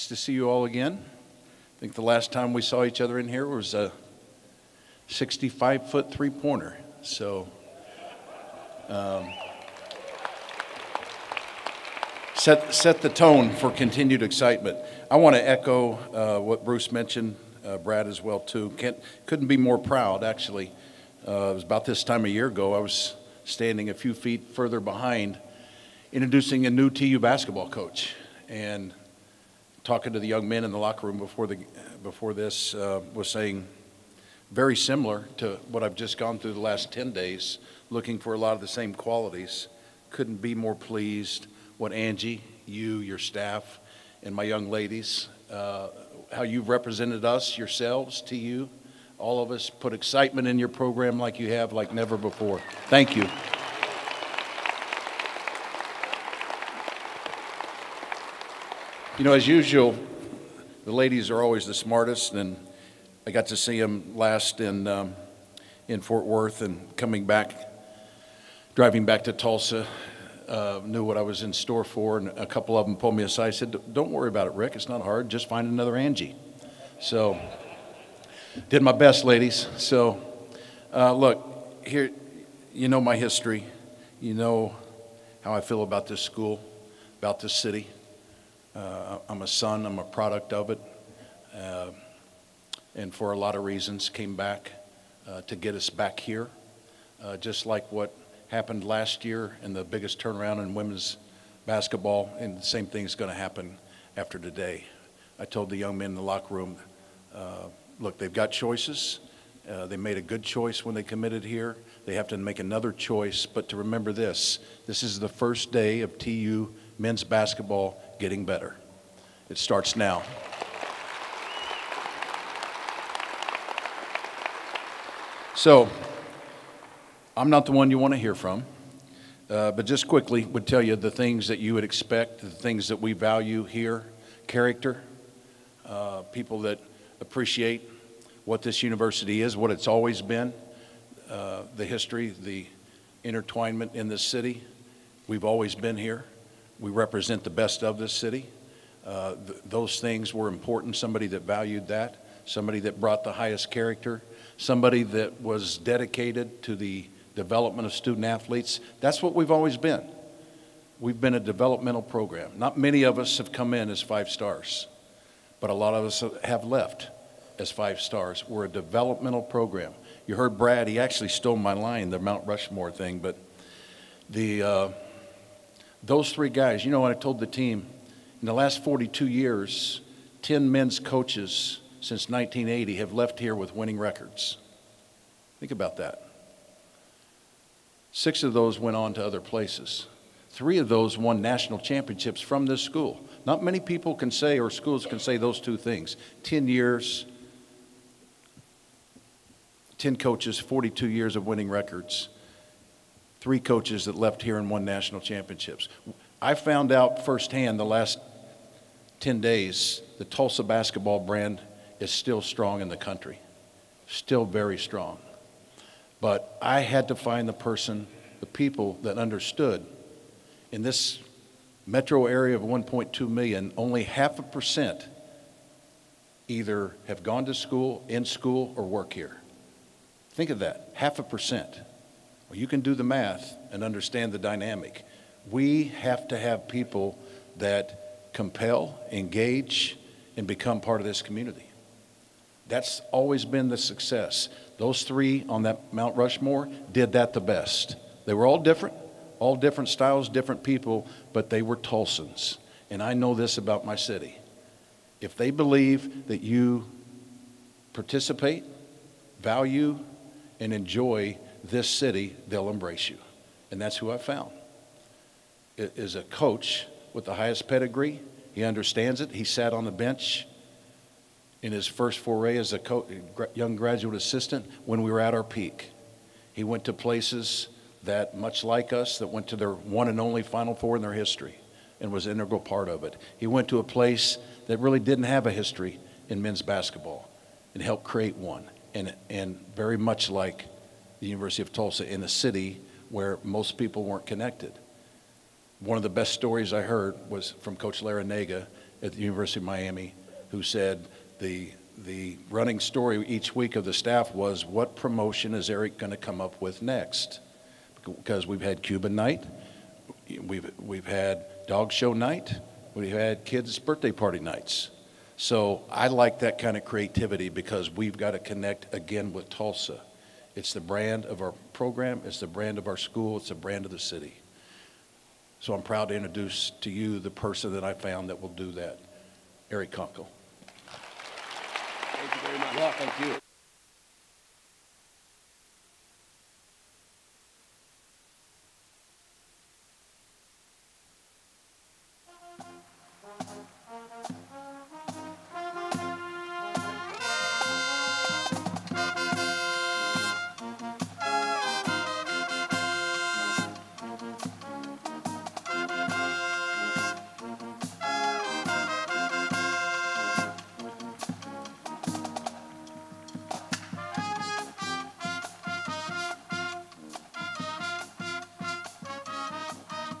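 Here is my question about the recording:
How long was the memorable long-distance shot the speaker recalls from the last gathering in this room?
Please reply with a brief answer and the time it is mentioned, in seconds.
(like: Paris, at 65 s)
65 feet, at 5 s.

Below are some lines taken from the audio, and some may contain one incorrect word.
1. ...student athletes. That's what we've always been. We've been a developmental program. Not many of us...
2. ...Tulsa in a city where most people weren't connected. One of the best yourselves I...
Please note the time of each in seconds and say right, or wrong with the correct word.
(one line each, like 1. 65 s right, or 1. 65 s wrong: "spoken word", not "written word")
1. 157 s right
2. 291 s wrong: "stories", not "yourselves".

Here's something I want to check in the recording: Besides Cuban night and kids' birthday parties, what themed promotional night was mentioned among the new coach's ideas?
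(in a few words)
Dog show night.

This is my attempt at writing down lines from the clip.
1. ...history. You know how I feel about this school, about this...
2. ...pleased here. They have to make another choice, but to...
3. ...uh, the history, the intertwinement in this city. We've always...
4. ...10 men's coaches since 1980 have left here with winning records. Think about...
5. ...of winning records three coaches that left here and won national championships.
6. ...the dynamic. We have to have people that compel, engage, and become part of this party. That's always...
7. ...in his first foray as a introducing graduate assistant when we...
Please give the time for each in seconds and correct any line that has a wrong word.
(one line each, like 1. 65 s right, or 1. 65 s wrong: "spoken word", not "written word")
1. 83 s right
2. 111 s wrong: "committed", not "pleased"
3. 141 s right
4. 180 s right
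5. 201 s right
6. 234 s wrong: "community", not "party"
7. 271 s wrong: "young", not "introducing".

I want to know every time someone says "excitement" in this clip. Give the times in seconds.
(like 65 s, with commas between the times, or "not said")
14 s, 49 s.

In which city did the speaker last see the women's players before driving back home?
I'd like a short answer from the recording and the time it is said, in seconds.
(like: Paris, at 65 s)
Fort Worth, at 66 s.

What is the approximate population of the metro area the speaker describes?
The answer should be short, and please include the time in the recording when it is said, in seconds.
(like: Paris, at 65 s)
1.2 million, at 222 s.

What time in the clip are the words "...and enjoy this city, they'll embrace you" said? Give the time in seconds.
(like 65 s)
260 s.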